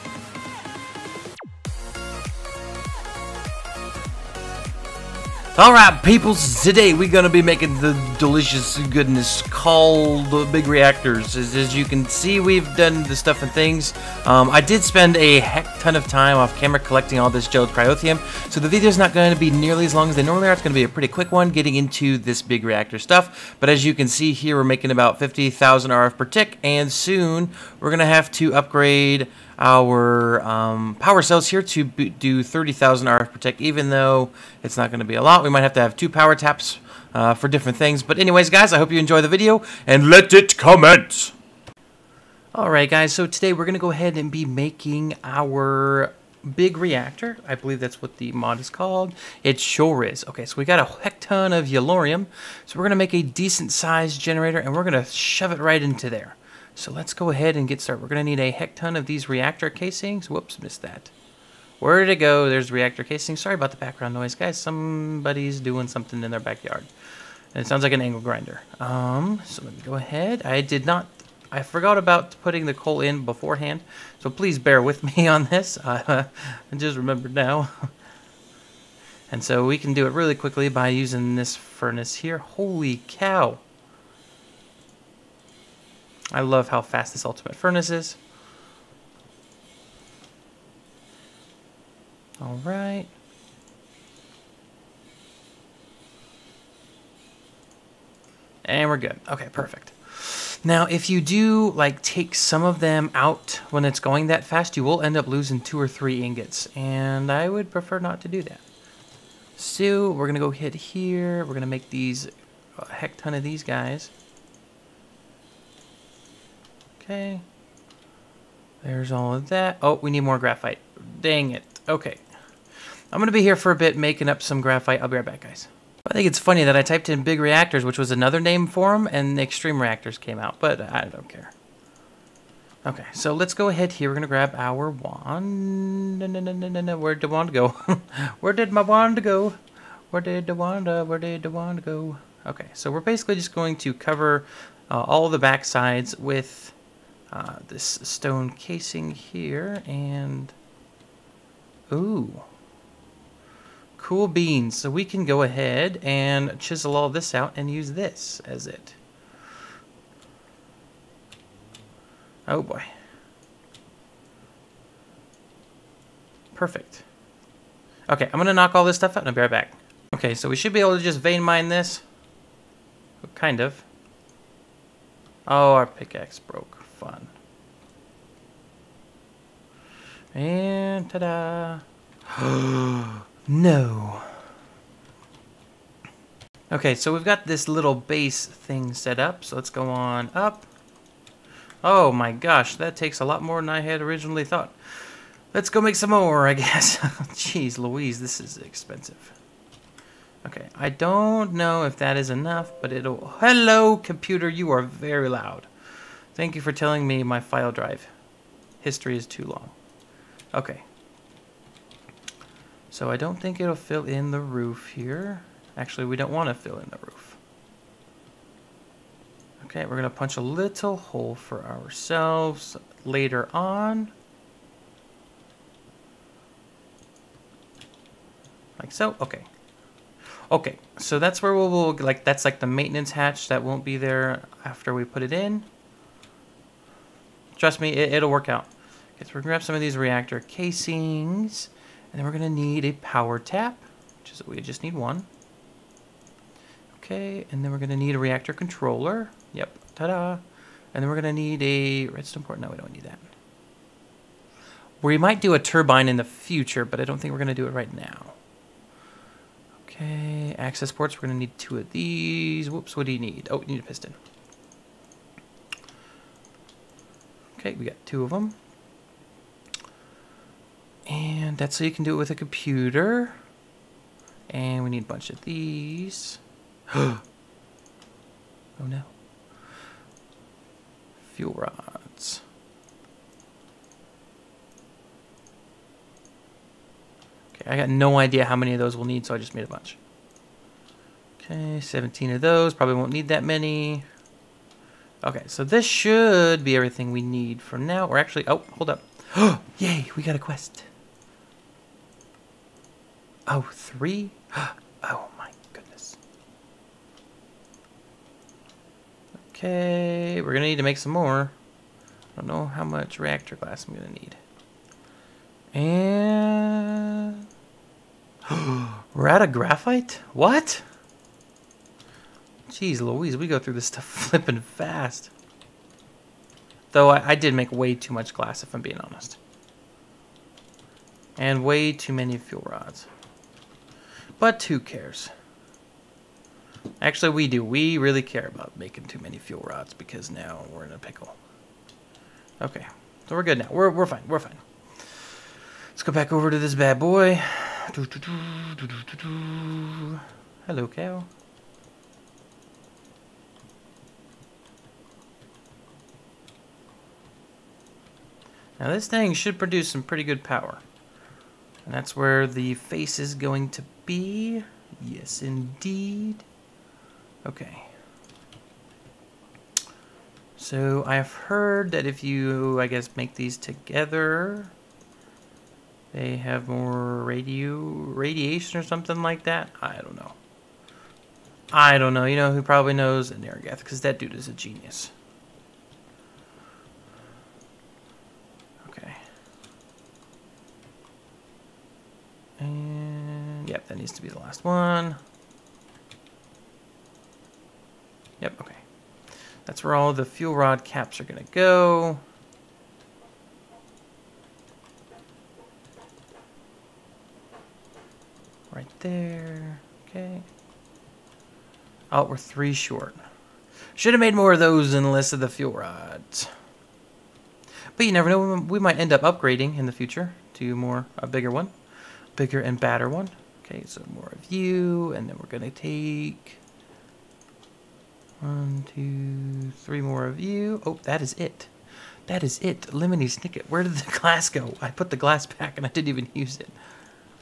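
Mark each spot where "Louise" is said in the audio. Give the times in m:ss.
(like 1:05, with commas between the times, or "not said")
3:17, 5:23.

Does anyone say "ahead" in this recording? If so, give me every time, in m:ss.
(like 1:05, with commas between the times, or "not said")
0:43, 0:57, 1:09, 2:13, 2:35.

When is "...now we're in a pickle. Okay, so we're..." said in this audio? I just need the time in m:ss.
5:40.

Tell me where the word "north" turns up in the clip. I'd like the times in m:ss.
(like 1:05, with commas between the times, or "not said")
not said.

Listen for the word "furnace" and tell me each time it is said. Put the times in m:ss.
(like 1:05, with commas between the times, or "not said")
1:21, 1:27.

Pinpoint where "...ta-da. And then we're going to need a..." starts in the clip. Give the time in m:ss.
4:09.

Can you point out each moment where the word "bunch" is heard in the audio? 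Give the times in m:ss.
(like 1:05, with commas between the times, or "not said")
4:35, 4:49.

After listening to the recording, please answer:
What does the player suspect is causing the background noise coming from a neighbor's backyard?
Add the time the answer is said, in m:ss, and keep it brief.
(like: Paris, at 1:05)
an angle grinder, at 1:07.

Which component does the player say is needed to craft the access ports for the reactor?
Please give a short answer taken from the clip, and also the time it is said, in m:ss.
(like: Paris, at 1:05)
a piston, at 4:23.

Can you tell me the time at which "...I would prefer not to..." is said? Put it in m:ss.
1:47.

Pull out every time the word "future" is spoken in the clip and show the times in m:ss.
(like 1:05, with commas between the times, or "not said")
4:16, 6:59.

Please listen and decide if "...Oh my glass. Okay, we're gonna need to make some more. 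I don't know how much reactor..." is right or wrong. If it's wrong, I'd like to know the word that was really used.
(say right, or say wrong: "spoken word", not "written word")
wrong: "goodness", not "glass".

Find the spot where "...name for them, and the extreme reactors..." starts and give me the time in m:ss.
2:08.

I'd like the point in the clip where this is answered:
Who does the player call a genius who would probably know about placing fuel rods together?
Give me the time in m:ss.
6:23.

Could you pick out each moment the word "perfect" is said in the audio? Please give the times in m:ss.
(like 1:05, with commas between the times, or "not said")
1:39, 2:46.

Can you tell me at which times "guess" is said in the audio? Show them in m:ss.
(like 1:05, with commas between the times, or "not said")
3:16, 6:12.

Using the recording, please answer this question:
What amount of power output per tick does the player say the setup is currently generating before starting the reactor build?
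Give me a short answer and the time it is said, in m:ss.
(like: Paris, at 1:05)
50,000 RF, at 0:25.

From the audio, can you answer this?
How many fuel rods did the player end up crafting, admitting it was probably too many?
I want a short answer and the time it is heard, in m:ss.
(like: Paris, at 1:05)
17, at 4:51.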